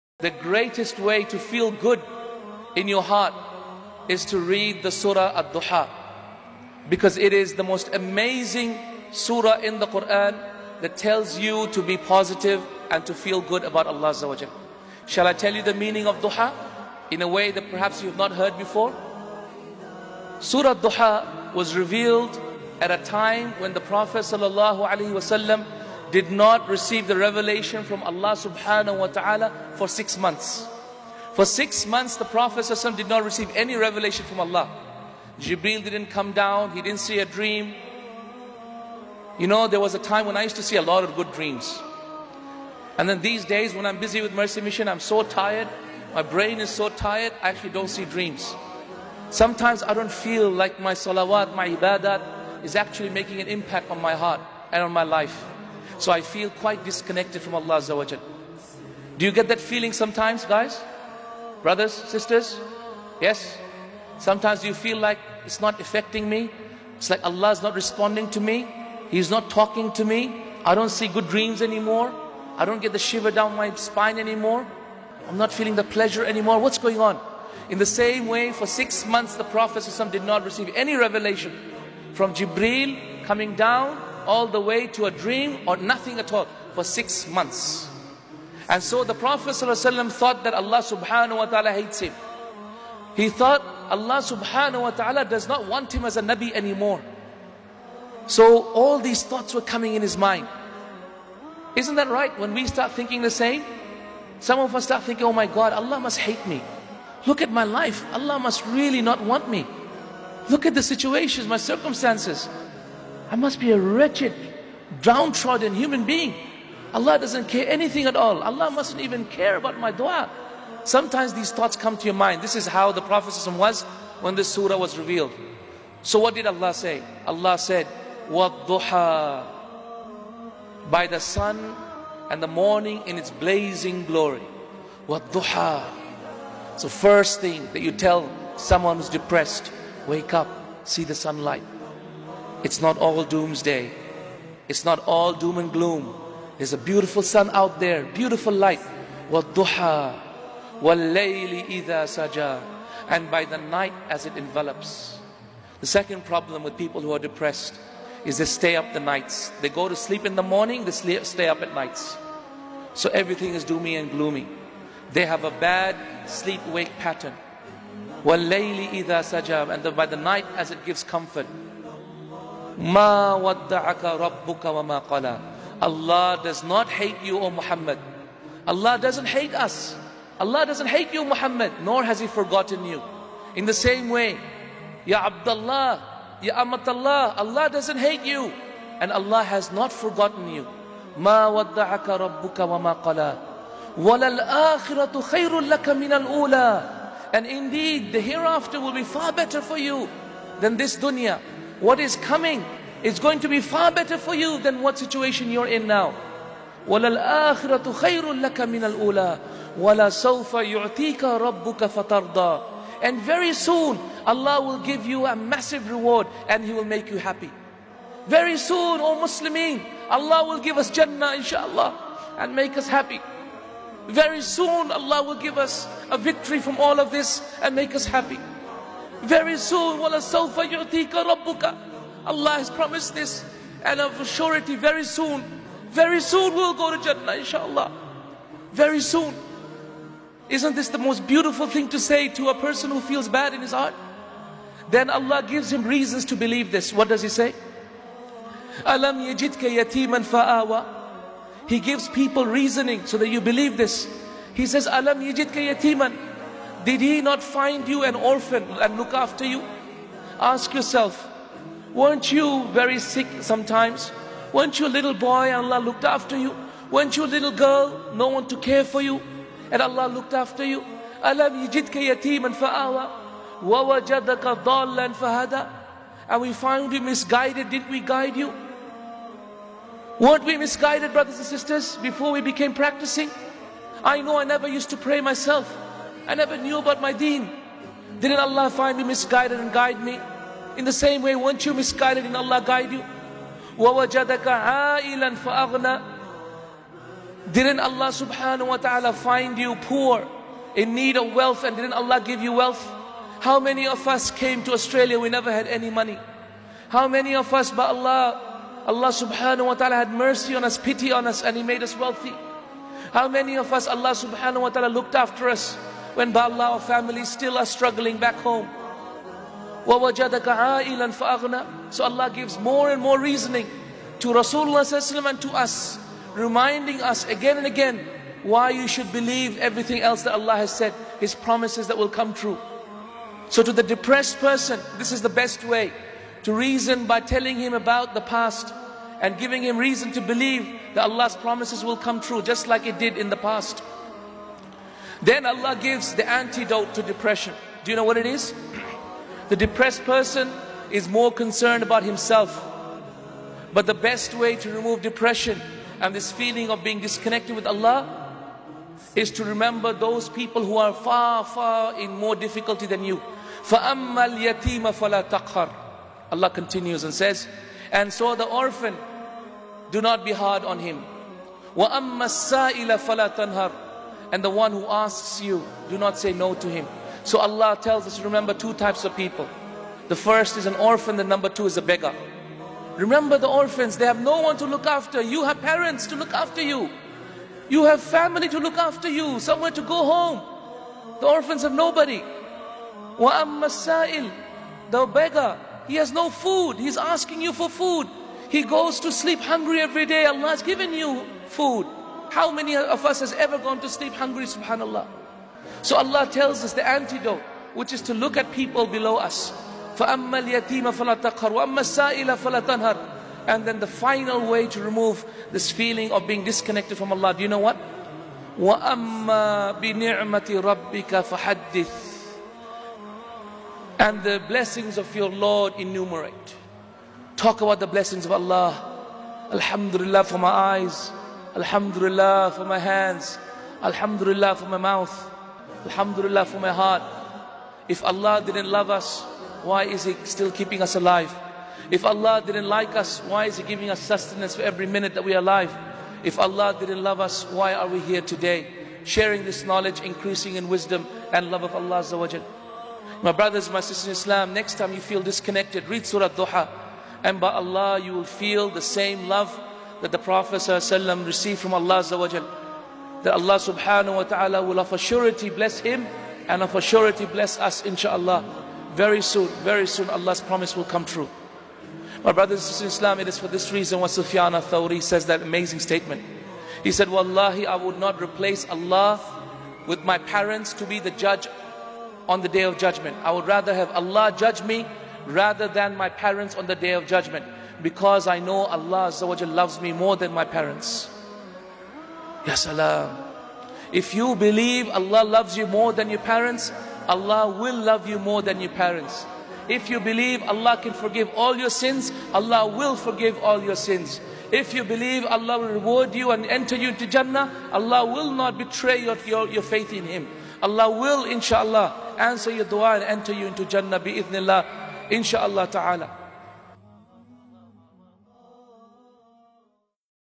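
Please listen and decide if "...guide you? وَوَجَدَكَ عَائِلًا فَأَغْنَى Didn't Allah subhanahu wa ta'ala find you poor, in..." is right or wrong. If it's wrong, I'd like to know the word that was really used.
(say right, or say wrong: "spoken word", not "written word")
right.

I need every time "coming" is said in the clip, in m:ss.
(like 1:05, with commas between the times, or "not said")
1:23, 1:39, 3:22.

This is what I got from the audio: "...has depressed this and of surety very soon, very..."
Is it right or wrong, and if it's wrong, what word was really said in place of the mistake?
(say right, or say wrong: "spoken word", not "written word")
wrong: "promised", not "depressed".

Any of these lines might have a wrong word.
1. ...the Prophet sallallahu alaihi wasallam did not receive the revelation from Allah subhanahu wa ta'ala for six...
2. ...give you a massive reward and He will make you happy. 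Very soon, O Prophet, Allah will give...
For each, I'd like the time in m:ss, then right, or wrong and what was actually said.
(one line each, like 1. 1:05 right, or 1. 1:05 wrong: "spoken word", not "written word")
1. 0:23 right
2. 3:34 wrong: "Muslimin", not "Prophet".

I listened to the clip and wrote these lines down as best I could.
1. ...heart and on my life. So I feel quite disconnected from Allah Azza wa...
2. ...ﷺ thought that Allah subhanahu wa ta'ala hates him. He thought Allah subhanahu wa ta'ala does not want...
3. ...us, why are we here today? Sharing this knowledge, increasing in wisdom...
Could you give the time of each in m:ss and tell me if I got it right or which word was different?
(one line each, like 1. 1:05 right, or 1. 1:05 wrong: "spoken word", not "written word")
1. 0:54 right
2. 1:29 right
3. 7:27 right.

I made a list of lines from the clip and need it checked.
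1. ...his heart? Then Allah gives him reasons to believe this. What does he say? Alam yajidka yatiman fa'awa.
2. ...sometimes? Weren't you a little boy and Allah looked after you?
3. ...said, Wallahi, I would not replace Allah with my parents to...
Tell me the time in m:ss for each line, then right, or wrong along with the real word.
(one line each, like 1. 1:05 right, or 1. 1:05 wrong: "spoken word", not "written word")
1. 4:03 right
2. 4:23 right
3. 7:56 right.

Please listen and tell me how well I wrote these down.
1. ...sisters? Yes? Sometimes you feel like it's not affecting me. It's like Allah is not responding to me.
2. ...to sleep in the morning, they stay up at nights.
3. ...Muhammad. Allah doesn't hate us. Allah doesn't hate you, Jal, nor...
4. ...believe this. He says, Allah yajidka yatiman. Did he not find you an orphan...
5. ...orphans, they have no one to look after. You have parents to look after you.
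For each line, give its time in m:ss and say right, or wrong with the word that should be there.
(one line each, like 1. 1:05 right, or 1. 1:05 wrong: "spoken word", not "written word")
1. 1:01 right
2. 2:39 right
3. 2:57 wrong: "Muhammad", not "Jal"
4. 4:13 wrong: "Alam", not "Allah"
5. 6:23 right.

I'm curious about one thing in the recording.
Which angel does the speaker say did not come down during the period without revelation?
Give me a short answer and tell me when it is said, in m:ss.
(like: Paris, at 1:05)
Jibril, at 0:35.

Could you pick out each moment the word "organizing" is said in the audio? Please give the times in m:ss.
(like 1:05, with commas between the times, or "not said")
not said.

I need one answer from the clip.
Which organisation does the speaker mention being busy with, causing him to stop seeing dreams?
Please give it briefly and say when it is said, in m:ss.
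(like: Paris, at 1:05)
Mercy Mission, at 0:44.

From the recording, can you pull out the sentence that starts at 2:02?
This is how the Prophet was when this surah was revealed.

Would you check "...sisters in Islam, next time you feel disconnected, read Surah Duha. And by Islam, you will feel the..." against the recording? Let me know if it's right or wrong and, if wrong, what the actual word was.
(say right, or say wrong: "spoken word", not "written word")
wrong: "Allah", not "Islam".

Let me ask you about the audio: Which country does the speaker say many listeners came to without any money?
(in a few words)
Australia.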